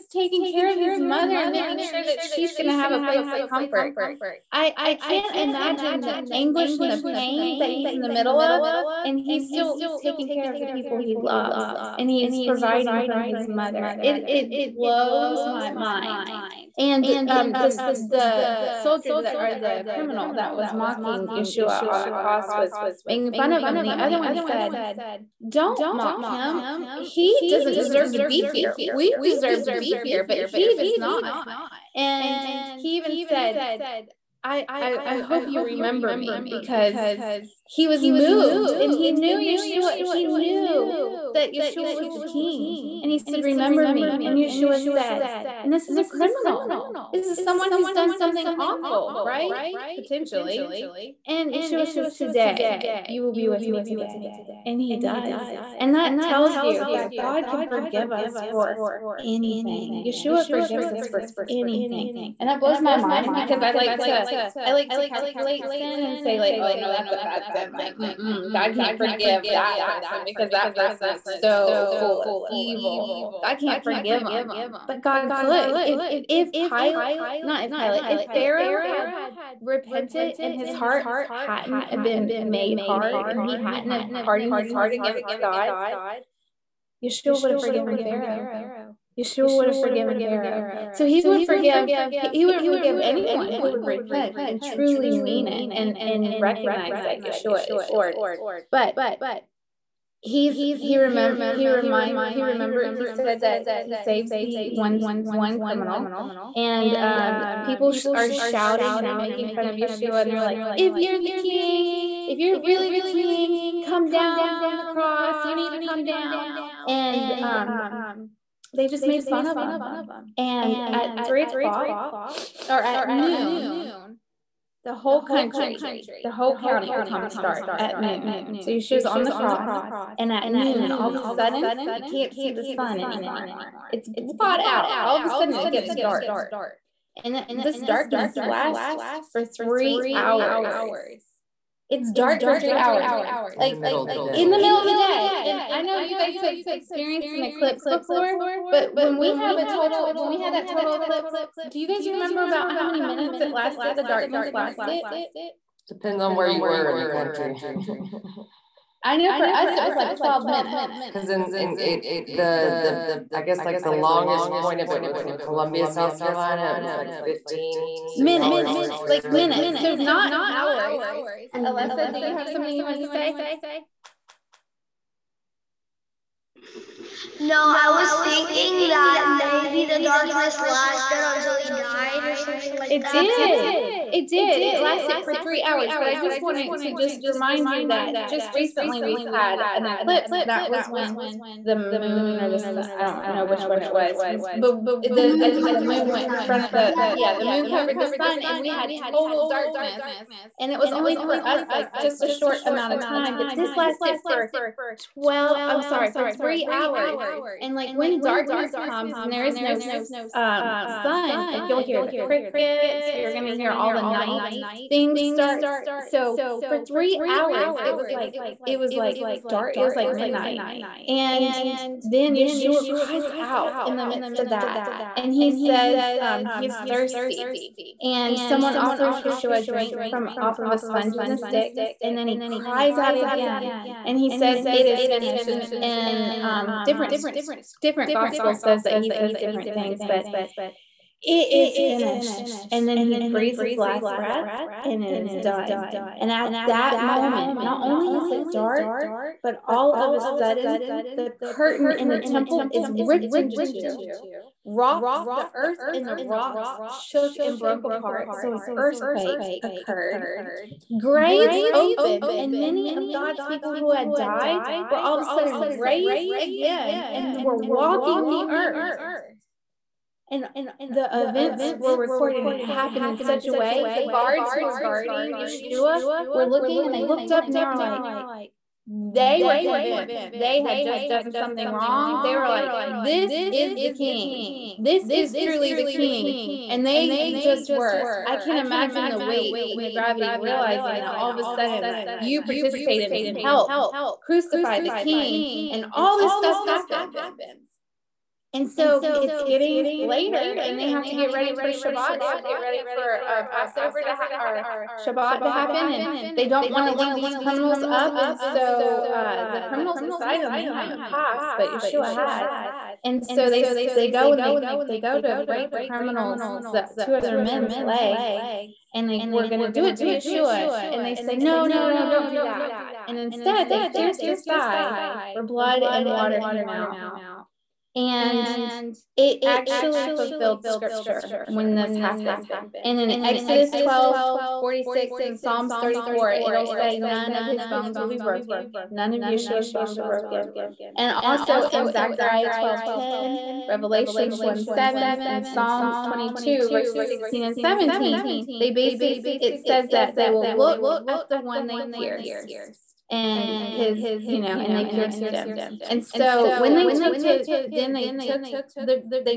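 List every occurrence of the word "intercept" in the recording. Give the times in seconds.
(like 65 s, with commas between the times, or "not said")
not said.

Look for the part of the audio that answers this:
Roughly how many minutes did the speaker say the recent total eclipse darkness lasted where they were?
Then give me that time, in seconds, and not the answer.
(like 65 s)
160 s.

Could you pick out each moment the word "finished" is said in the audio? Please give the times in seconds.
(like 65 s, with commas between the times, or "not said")
235 s, 241 s.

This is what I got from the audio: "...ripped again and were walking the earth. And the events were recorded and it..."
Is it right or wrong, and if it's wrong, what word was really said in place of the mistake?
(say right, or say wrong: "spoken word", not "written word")
wrong: "raised", not "ripped".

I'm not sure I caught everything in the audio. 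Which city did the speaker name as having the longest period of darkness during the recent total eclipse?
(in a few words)
Columbia, South Carolina.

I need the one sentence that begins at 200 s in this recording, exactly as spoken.
And it was only for us, like just a short amount of time.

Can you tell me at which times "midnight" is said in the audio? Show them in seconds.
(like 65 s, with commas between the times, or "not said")
220 s.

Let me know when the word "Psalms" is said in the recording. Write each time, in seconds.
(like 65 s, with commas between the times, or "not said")
335 s, 345 s.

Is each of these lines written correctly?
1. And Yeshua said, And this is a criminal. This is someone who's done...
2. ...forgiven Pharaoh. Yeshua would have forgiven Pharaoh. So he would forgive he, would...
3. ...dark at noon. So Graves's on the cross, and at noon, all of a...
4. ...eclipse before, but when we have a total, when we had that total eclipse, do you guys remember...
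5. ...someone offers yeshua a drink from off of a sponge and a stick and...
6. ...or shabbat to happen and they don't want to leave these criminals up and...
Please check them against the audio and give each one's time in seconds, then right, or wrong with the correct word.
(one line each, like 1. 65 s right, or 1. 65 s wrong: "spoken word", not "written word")
1. 44 s right
2. 87 s right
3. 127 s wrong: "Yeshua", not "Graves"
4. 147 s right
5. 228 s right
6. 304 s right.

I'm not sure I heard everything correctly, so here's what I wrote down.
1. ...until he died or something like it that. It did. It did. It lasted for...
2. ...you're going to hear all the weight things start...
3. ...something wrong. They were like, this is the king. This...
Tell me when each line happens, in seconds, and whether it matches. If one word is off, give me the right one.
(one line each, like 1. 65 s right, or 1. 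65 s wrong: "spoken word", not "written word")
1. 181 s right
2. 213 s wrong: "night", not "weight"
3. 281 s right.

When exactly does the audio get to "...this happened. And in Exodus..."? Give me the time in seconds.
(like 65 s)
331 s.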